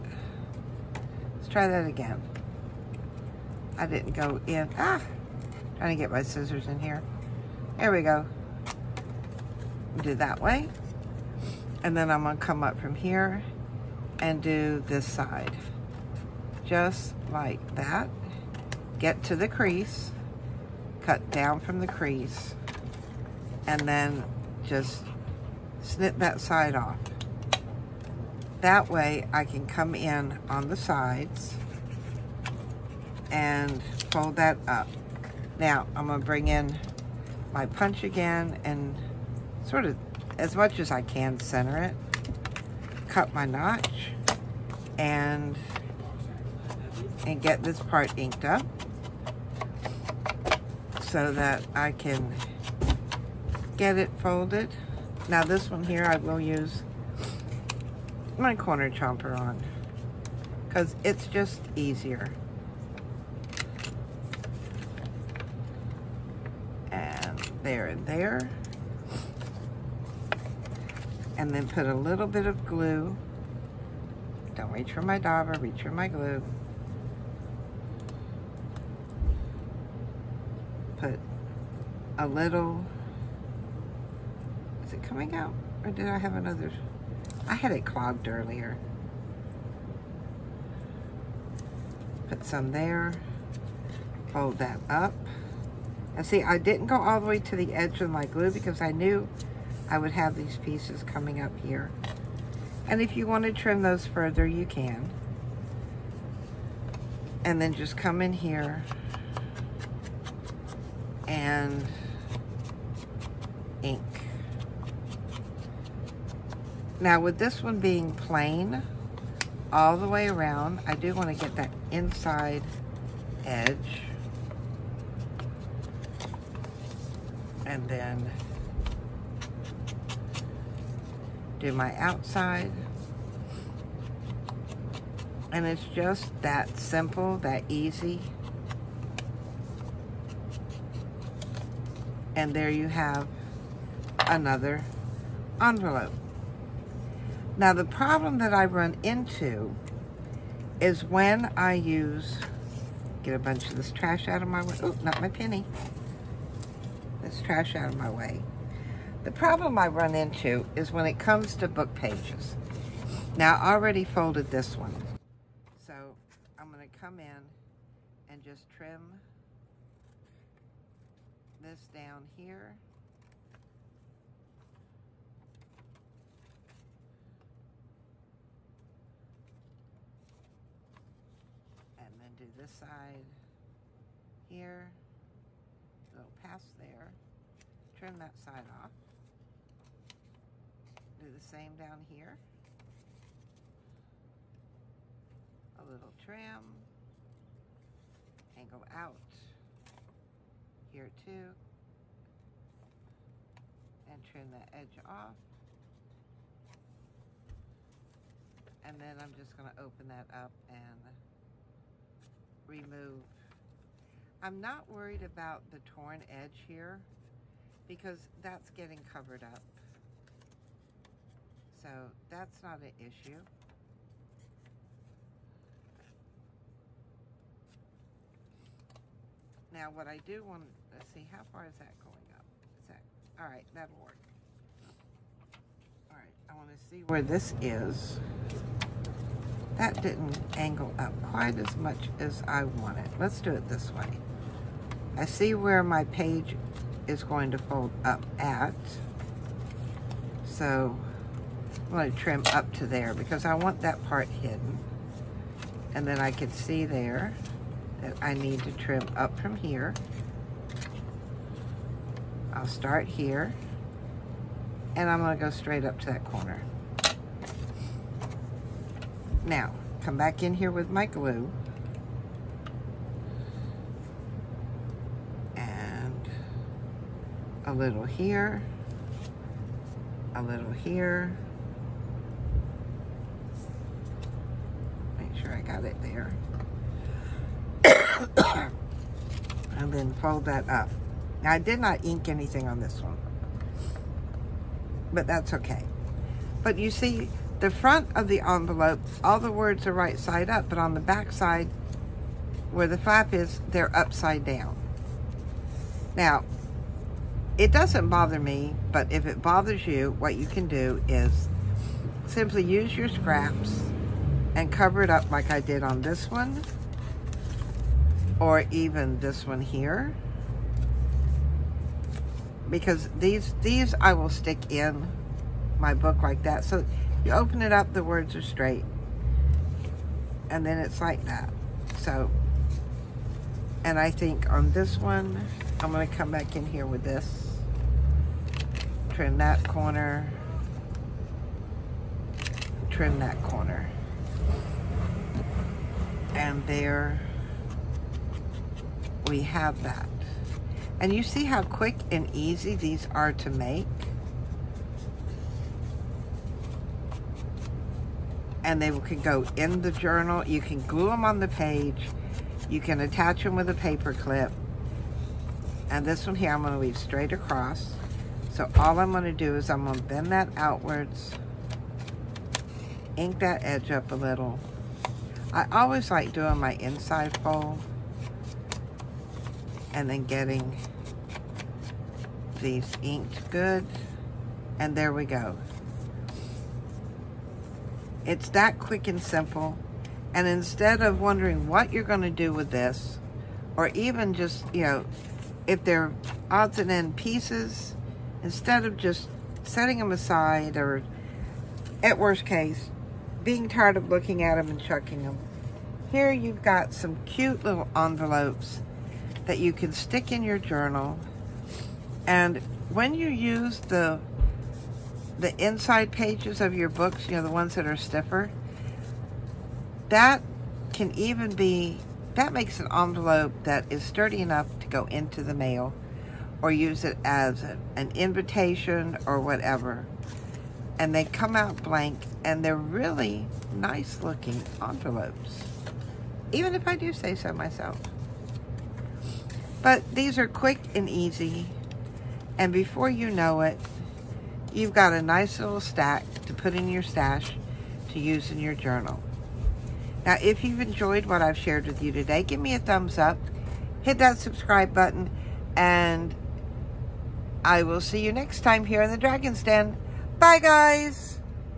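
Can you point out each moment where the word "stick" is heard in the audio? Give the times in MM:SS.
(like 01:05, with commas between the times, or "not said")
05:24, 06:49.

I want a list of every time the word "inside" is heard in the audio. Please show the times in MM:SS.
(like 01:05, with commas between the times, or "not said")
02:01, 06:16, 06:55.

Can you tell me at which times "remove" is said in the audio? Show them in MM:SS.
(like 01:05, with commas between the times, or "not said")
03:32.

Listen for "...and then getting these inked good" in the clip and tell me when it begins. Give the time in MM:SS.
06:19.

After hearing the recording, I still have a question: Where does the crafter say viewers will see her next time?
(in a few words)
the Dragon's Den.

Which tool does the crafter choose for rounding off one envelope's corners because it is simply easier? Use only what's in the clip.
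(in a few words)
corner chomper.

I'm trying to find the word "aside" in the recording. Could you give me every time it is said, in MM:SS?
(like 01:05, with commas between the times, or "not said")
06:40.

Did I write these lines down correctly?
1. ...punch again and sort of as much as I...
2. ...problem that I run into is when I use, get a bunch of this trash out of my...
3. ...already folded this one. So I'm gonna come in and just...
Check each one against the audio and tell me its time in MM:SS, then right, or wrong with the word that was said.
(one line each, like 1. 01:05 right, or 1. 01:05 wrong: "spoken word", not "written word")
1. 00:37 right
2. 02:27 right
3. 02:43 right.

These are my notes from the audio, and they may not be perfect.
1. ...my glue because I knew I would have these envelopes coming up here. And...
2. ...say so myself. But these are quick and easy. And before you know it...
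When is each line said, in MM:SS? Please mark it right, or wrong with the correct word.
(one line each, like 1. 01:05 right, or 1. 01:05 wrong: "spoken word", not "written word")
1. 01:38 wrong: "pieces", not "envelopes"
2. 07:17 right.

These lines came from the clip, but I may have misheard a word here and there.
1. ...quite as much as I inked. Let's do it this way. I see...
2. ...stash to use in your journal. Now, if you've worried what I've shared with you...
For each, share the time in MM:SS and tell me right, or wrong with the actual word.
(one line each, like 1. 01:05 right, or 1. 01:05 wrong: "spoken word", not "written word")
1. 04:01 wrong: "wanted", not "inked"
2. 07:27 wrong: "enjoyed", not "worried".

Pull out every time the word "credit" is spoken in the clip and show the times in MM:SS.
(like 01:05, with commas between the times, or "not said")
not said.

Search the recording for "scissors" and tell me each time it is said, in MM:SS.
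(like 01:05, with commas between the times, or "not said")
00:06.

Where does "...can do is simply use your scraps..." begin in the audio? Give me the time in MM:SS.
05:10.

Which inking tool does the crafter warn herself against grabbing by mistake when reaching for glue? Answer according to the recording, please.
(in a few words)
dauber.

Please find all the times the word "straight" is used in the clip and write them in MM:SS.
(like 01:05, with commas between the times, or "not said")
04:25, 05:28, 06:06.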